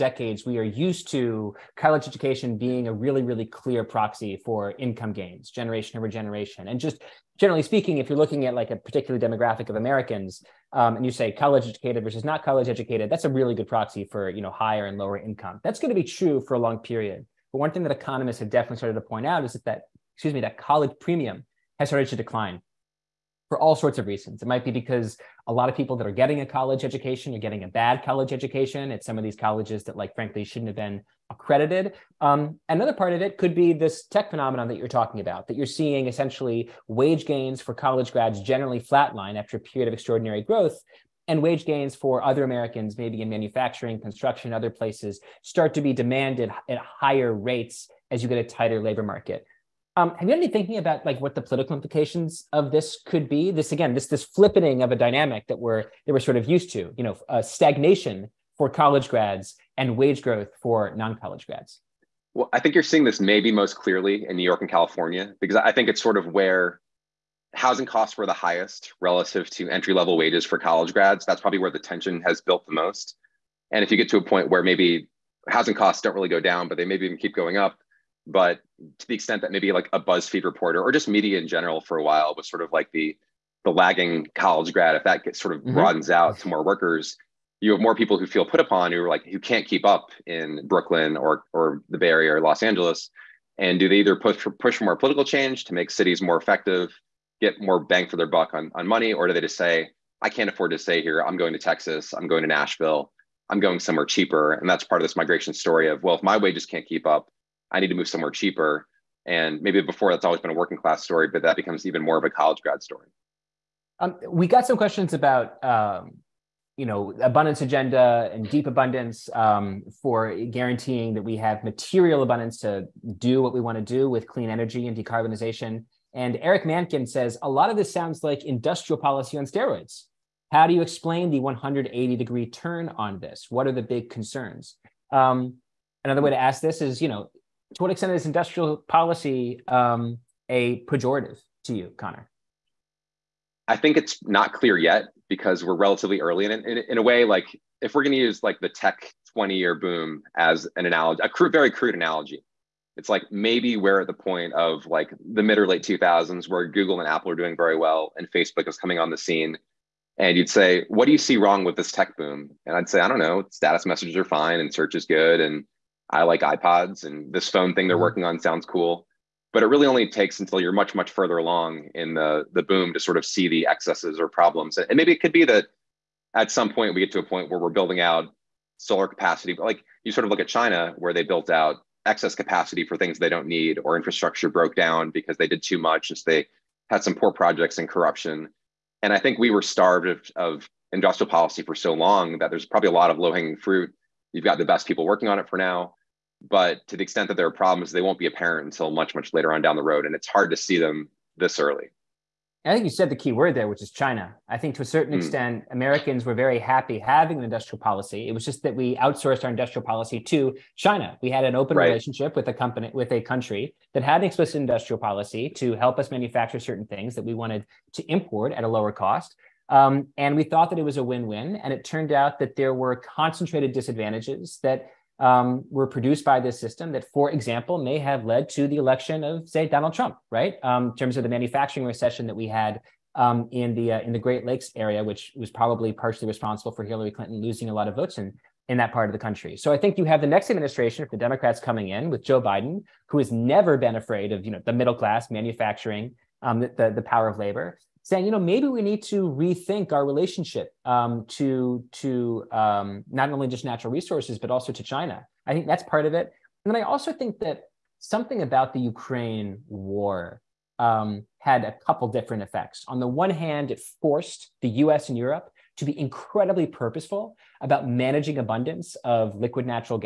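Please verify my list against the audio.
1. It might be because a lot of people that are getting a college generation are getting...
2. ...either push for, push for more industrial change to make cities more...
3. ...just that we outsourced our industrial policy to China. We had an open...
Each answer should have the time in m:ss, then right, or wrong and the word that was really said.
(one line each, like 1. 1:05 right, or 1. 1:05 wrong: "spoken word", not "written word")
1. 0:24 wrong: "education", not "generation"
2. 1:33 wrong: "political", not "industrial"
3. 3:28 right.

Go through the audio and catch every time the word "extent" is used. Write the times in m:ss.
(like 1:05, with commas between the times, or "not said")
1:19, 2:17, 3:17, 3:25.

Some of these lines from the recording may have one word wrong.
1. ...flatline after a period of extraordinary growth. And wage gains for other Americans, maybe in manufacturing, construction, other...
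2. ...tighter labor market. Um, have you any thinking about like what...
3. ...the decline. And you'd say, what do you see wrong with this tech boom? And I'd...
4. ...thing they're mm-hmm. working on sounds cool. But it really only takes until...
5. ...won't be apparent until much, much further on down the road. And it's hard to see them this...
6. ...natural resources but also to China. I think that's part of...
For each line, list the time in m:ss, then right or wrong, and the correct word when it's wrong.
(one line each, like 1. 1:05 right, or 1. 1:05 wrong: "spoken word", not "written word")
1. 0:38 right
2. 0:48 right
3. 2:39 wrong: "scene", not "decline"
4. 2:47 right
5. 3:18 wrong: "later", not "further"
6. 4:13 right.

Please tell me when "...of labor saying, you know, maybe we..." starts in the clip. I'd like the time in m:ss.
4:07.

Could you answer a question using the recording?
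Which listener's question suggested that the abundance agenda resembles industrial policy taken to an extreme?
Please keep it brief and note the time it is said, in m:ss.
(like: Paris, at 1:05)
Eric Mankin, at 2:06.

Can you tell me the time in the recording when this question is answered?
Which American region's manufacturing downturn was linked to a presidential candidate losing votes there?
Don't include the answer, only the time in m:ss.
3:54.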